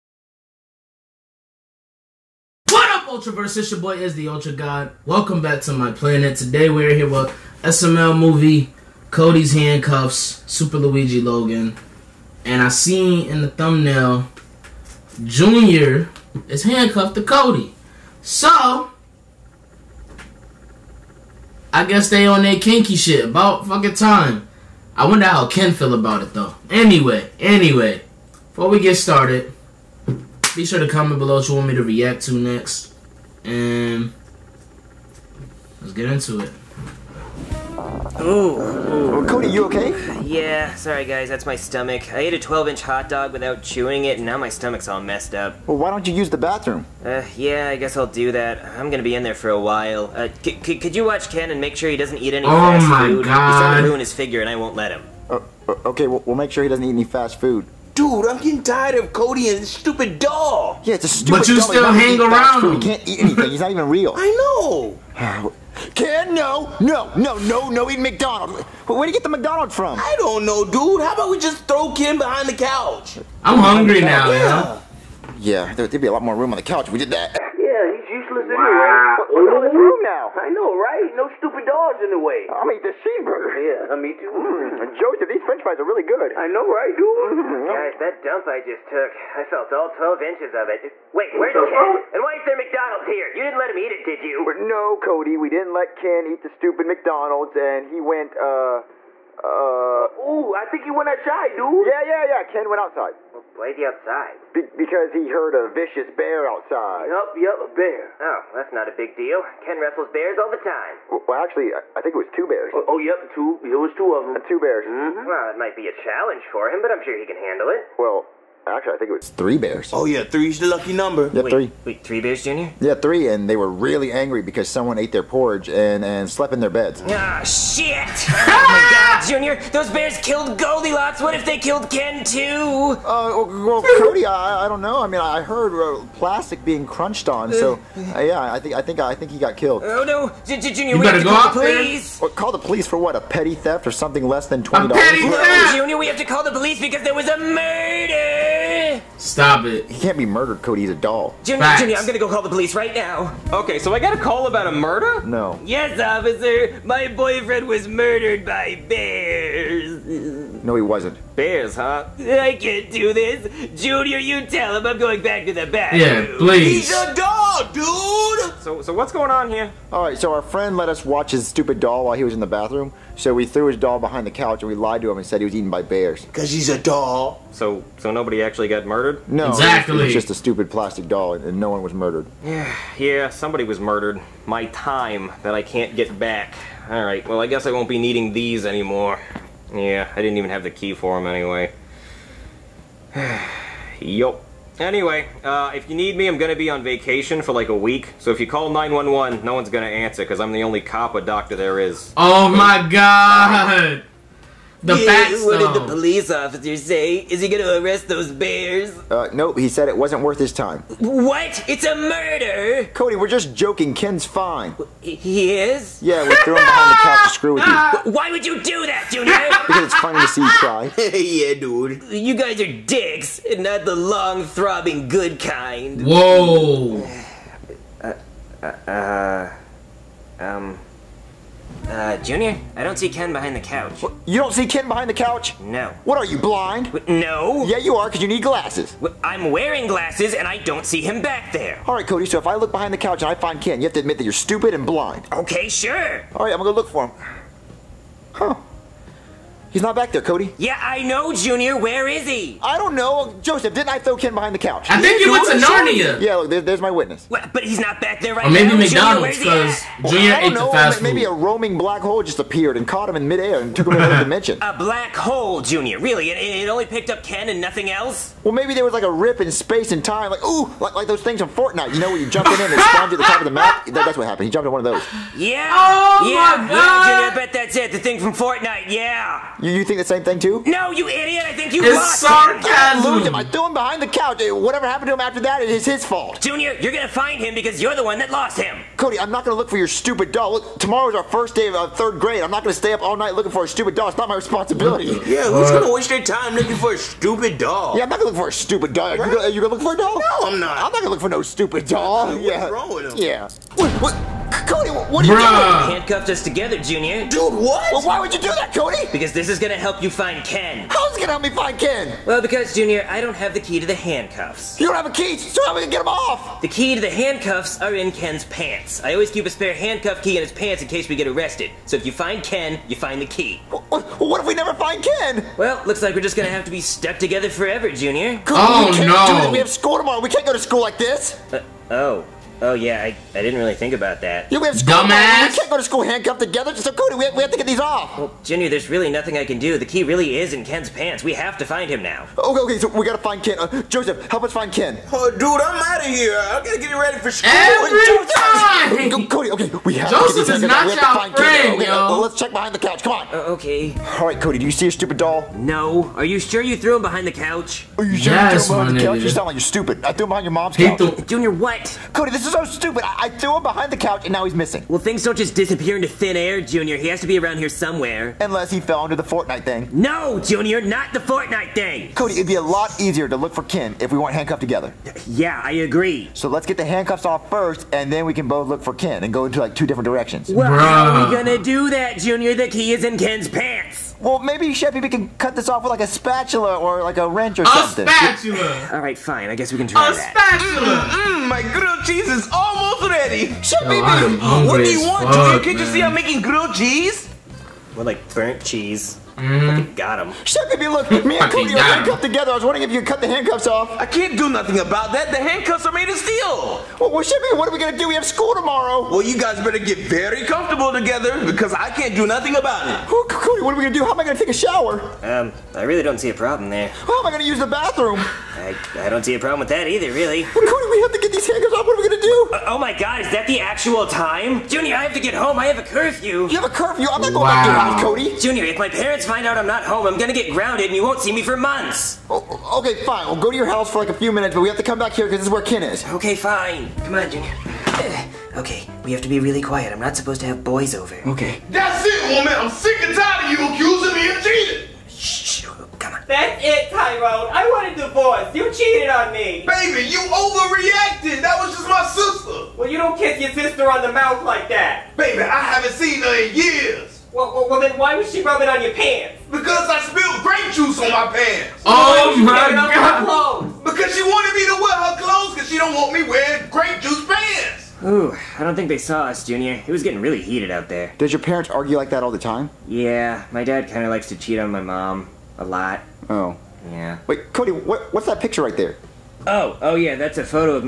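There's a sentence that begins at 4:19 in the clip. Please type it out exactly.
McDonald's, because Junior well, I don't ate know, the fast Maybe food.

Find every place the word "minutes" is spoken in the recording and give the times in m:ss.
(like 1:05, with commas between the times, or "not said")
7:14.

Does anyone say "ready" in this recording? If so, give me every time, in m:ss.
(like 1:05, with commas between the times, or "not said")
5:46, 6:33.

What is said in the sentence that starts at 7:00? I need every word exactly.
Well, Cody, we have to get these hangers off.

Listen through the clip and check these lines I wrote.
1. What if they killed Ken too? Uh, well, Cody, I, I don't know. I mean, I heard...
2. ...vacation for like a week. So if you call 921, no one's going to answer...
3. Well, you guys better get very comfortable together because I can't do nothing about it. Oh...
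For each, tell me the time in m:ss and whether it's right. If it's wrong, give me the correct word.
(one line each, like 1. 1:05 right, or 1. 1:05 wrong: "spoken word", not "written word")
1. 2:11 right
2. 3:16 wrong: "911", not "921"
3. 6:49 right.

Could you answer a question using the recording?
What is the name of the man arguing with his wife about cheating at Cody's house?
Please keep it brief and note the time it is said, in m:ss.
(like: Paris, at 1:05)
Tyrone, at 7:26.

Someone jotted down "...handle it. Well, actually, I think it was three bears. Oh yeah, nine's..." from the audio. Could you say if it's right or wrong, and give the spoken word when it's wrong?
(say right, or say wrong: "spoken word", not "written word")
wrong: "three", not "nine".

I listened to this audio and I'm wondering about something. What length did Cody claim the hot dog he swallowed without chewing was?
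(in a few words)
12 inch.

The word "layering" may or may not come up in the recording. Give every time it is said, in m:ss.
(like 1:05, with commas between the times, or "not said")
not said.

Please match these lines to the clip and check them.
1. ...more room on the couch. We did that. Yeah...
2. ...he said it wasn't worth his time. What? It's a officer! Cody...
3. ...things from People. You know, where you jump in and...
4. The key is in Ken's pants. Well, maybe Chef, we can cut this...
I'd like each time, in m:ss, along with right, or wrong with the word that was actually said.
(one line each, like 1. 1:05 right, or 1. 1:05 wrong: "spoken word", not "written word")
1. 1:16 right
2. 3:29 wrong: "murder", not "officer"
3. 4:31 wrong: "Fortnite", not "People"
4. 6:22 right.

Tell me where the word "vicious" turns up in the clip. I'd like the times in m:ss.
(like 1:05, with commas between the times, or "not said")
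1:45.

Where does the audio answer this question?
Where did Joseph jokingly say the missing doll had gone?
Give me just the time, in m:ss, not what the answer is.
4:15.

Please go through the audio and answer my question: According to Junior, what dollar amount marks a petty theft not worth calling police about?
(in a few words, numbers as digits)
20.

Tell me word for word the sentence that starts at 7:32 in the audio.
Well, you don't kiss your sister on the mouth like that.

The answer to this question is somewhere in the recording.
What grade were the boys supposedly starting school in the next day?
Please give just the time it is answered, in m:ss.
4:51.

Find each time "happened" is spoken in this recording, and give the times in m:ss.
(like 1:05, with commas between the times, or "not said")
4:34, 4:44.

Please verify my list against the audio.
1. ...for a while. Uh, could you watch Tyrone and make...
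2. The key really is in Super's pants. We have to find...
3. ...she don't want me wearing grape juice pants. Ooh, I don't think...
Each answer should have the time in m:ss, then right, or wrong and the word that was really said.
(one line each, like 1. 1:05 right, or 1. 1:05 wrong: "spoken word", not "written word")
1. 0:49 wrong: "Ken", not "Tyrone"
2. 5:39 wrong: "Ken", not "Super"
3. 7:45 right.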